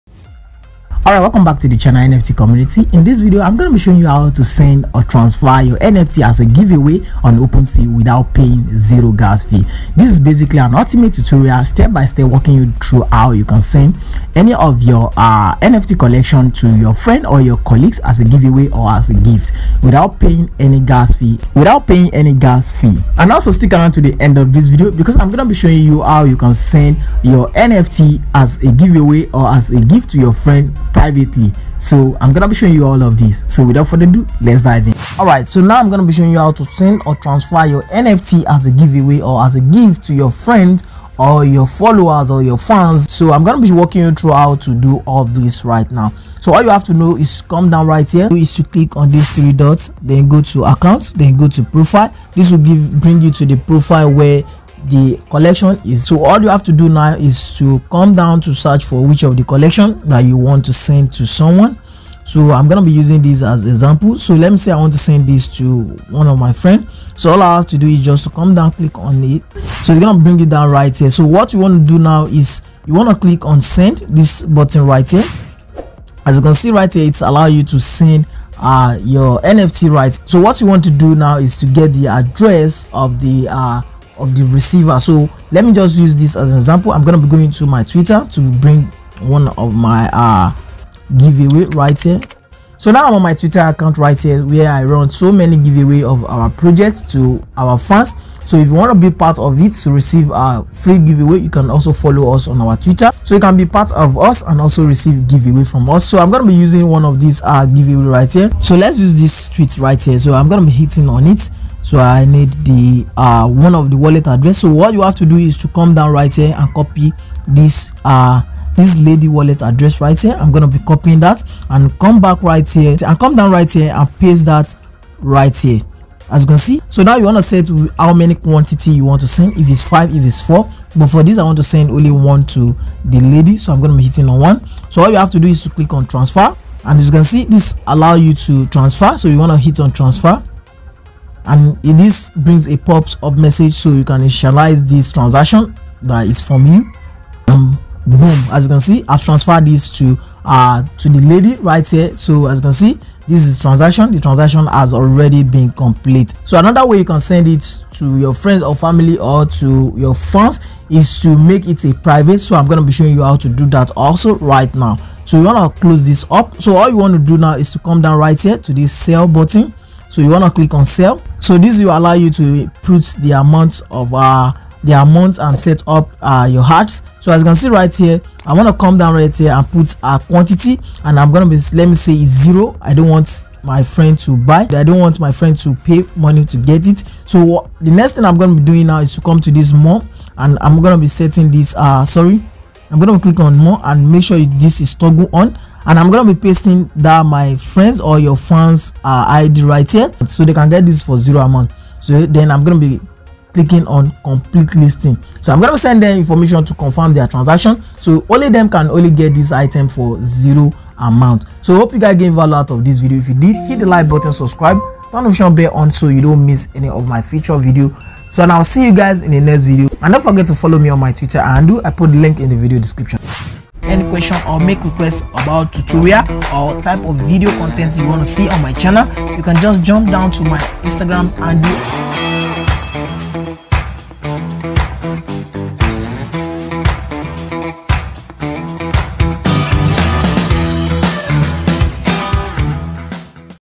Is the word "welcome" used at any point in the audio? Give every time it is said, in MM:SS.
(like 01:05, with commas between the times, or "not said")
00:01.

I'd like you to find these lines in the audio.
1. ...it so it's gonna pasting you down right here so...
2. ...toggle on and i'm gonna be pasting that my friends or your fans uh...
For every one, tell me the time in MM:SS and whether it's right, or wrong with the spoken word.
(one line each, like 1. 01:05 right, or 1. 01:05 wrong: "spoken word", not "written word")
1. 01:09 wrong: "bring", not "pasting"
2. 03:14 right.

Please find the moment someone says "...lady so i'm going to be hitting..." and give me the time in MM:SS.
02:13.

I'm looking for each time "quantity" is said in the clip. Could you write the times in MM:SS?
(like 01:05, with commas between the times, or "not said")
02:08, 03:00.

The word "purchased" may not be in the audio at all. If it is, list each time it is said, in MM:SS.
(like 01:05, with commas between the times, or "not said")
not said.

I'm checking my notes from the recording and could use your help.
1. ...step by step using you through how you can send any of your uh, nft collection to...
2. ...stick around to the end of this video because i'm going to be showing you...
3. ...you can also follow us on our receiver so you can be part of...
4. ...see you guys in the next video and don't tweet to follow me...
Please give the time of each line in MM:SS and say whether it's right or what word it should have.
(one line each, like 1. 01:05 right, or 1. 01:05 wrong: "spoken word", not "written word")
1. 00:11 wrong: "walking", not "using"
2. 00:23 right
3. 01:41 wrong: "twitter", not "receiver"
4. 03:38 wrong: "forget", not "tweet".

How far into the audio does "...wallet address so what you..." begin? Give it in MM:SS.
01:53.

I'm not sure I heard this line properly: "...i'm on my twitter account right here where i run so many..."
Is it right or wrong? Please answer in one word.
right.